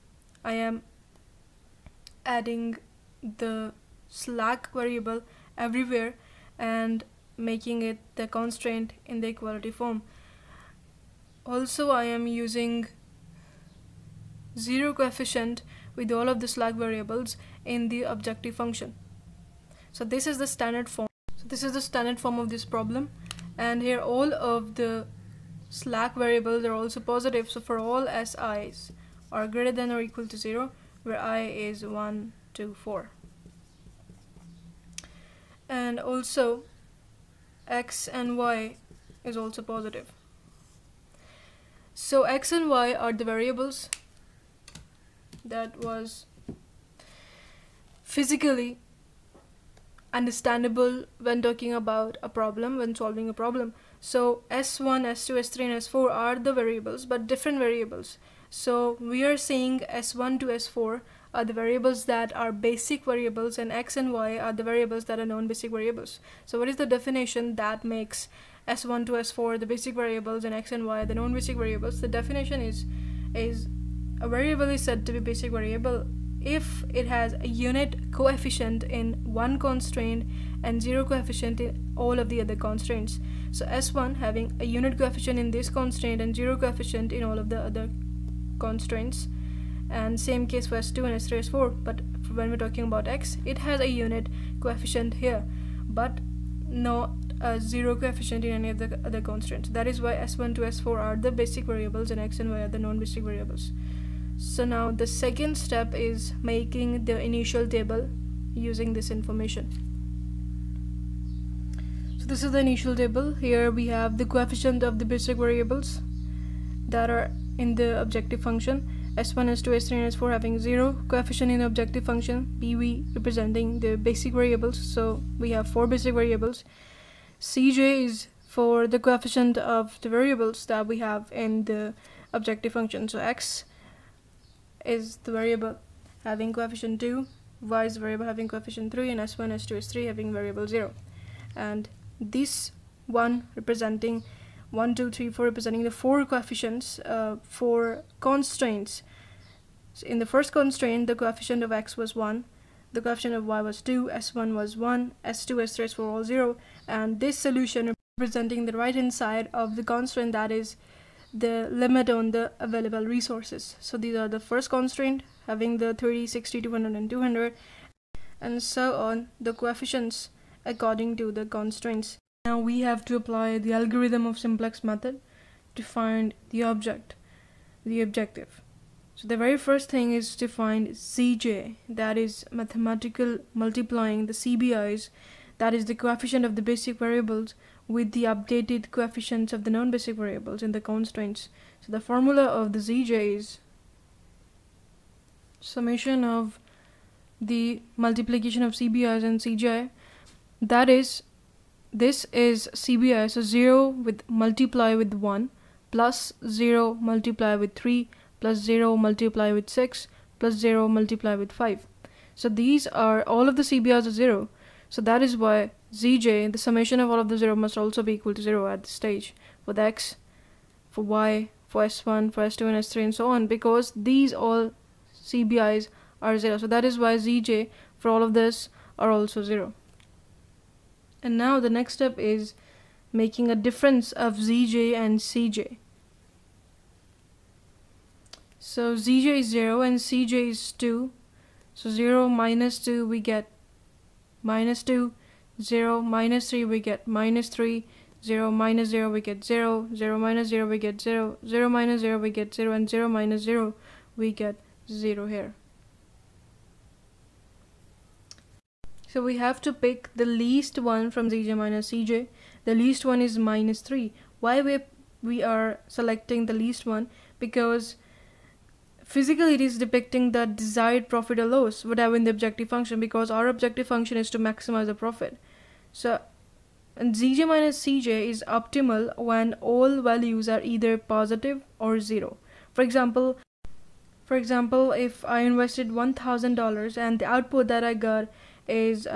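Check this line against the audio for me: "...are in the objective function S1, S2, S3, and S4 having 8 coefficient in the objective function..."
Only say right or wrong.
wrong.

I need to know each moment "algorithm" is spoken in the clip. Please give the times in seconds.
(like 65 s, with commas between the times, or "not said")
173 s.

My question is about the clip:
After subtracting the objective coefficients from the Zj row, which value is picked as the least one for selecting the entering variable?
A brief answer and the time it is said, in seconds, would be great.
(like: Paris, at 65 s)
-3, at 262 s.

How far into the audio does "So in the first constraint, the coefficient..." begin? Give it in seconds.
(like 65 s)
149 s.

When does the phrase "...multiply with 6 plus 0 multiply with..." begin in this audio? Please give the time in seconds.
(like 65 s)
208 s.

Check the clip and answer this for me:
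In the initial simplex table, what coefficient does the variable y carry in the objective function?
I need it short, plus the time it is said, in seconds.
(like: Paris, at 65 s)
3, at 137 s.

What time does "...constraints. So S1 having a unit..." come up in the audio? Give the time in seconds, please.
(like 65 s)
82 s.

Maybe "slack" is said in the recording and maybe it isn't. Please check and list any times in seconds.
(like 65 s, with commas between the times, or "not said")
4 s, 16 s, 25 s.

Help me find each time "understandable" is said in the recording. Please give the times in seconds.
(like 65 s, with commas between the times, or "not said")
50 s.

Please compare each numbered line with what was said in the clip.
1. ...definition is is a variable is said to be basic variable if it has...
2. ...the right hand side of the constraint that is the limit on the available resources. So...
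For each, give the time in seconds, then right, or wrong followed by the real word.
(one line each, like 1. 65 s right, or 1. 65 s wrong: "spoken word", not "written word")
1. 72 s right
2. 158 s right.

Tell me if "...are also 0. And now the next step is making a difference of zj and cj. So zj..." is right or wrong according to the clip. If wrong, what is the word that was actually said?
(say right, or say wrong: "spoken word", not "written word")
right.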